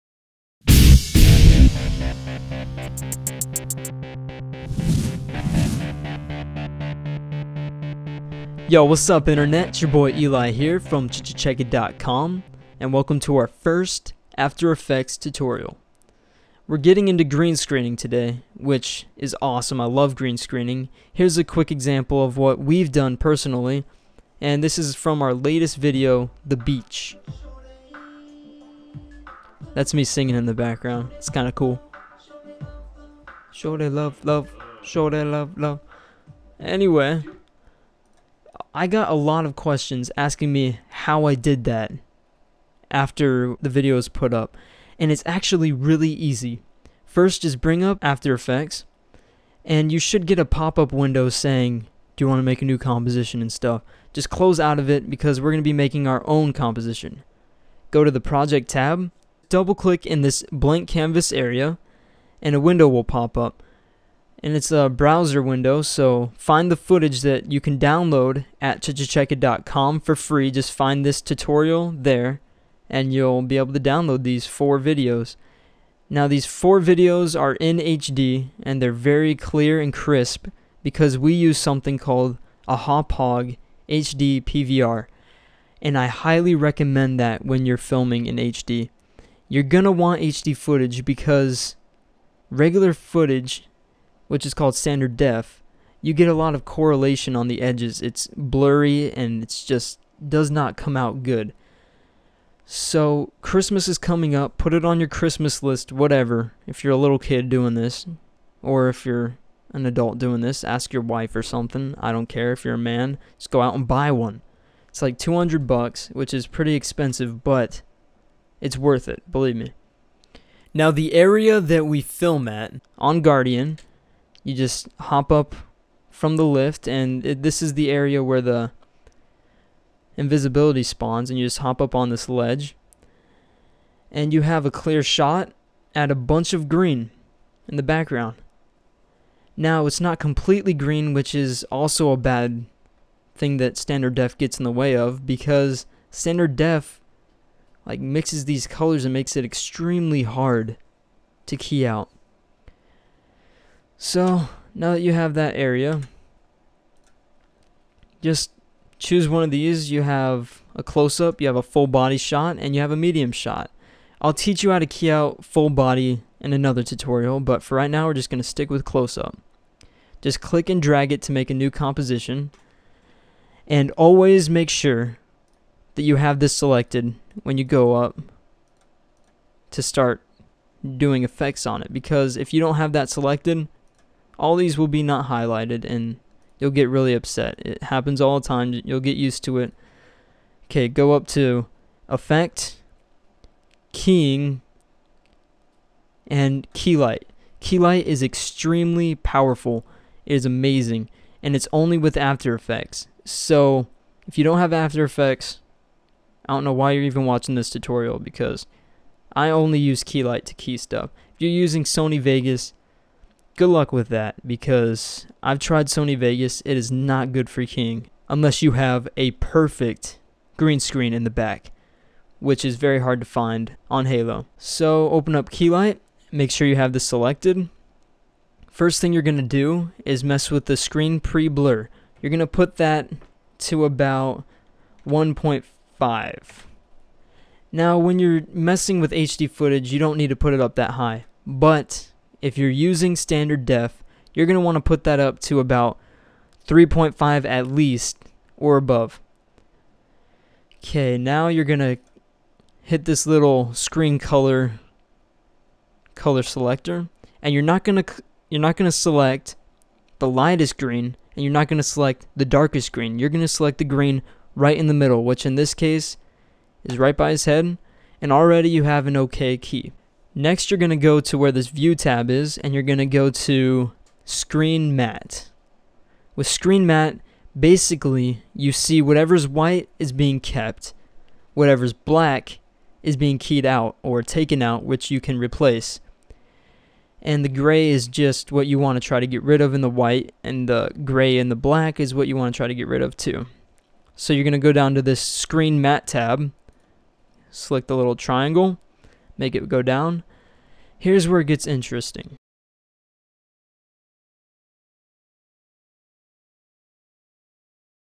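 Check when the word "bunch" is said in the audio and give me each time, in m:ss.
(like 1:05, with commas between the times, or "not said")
2:16.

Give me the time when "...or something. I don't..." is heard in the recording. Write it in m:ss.
1:51.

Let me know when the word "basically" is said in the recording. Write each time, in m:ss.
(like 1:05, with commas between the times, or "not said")
4:37.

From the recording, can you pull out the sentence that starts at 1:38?
It's blurry and it's just does not come out good.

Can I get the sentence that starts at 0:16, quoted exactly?
We're getting into green screening today, which is awesome.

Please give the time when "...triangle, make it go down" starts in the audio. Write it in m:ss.
4:58.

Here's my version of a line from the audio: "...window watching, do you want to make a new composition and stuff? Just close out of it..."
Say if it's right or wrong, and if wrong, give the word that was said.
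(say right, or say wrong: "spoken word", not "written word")
wrong: "saying", not "watching".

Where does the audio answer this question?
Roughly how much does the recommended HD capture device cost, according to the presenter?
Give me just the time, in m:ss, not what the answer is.
1:55.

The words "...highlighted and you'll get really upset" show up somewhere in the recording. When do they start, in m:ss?
3:05.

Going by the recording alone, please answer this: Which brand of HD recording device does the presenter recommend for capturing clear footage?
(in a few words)
Hauppauge HD PVR.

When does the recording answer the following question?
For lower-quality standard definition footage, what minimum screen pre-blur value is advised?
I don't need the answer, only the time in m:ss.
4:06.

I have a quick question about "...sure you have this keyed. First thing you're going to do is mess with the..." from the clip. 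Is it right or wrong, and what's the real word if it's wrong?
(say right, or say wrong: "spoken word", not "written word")
wrong: "selected", not "keyed".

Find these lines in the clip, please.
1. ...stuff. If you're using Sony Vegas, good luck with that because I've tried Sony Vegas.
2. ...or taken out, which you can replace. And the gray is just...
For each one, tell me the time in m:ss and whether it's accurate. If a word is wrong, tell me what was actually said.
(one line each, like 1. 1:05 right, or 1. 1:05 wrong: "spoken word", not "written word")
1. 3:30 right
2. 4:44 right.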